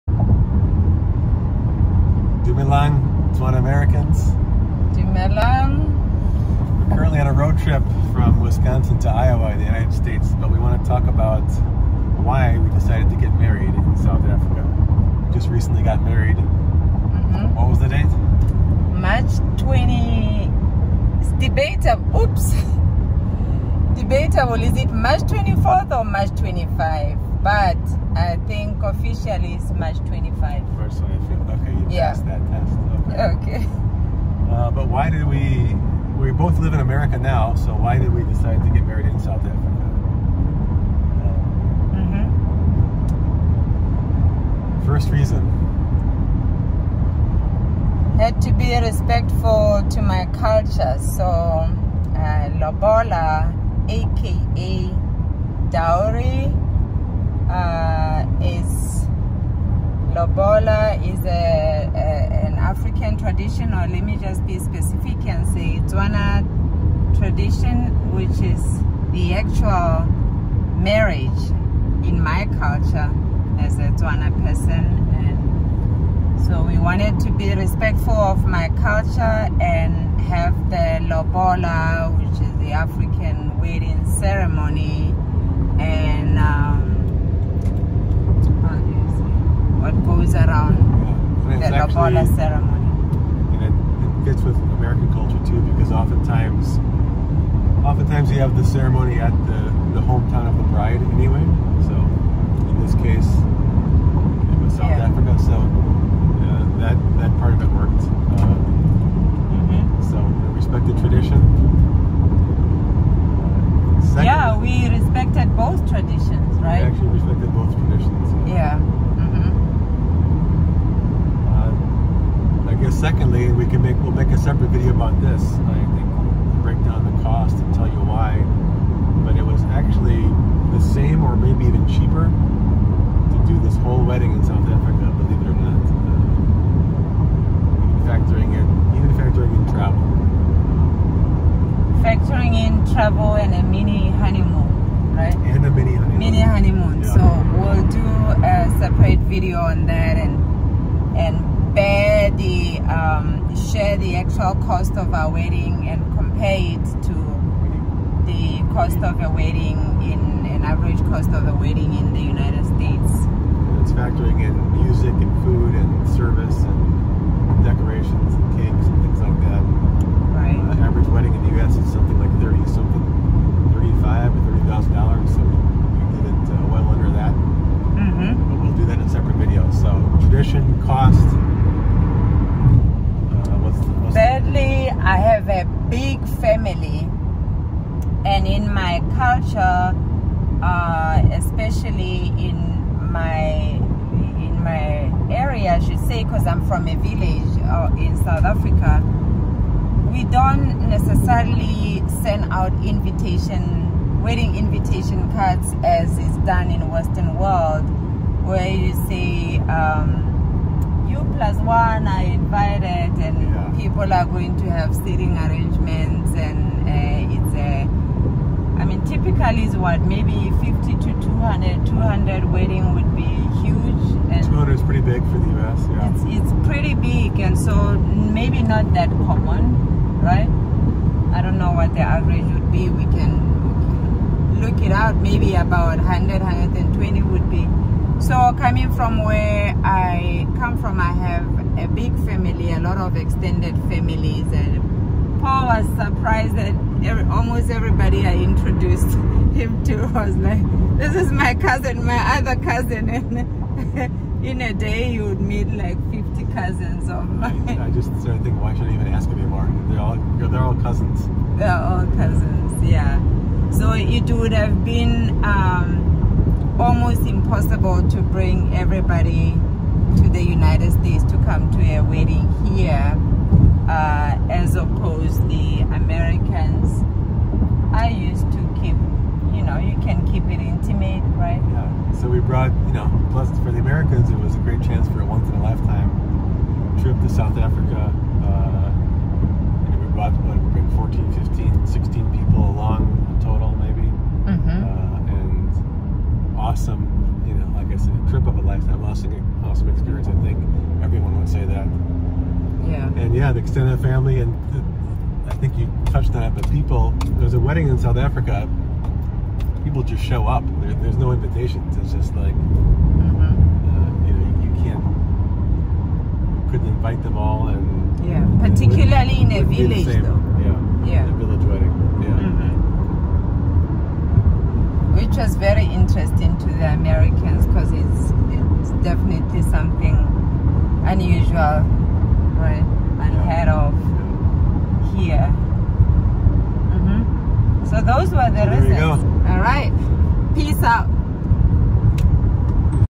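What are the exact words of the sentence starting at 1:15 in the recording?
And so we wanted to be respectful of my culture and have the Lobola, which is the African wedding ceremony, the mm-hmm.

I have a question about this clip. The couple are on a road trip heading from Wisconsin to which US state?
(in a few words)
Iowa.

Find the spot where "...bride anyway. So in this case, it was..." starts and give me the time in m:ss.
1:40.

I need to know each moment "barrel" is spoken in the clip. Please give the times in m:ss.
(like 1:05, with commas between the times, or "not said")
not said.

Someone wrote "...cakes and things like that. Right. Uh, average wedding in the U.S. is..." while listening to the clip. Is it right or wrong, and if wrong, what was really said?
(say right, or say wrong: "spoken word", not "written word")
right.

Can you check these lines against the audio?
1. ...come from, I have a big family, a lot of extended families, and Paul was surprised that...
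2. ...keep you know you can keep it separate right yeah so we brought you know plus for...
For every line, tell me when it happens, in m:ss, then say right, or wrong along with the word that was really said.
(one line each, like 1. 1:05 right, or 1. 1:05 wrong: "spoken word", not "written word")
1. 4:00 right
2. 4:38 wrong: "intimate", not "separate".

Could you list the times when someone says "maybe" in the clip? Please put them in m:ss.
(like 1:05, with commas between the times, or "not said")
3:40, 3:48, 3:55.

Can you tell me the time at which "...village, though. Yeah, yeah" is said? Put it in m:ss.
5:19.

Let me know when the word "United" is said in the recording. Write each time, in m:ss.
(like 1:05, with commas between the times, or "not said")
0:09, 2:42, 4:30.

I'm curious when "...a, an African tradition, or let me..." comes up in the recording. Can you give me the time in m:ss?
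1:01.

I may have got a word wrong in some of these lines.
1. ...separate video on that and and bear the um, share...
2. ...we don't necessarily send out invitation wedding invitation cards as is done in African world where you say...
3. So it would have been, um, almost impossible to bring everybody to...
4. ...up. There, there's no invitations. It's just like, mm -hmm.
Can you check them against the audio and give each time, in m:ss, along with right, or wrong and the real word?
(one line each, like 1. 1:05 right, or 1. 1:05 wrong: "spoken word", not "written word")
1. 2:28 right
2. 3:20 wrong: "Western", not "African"
3. 4:23 right
4. 5:10 right.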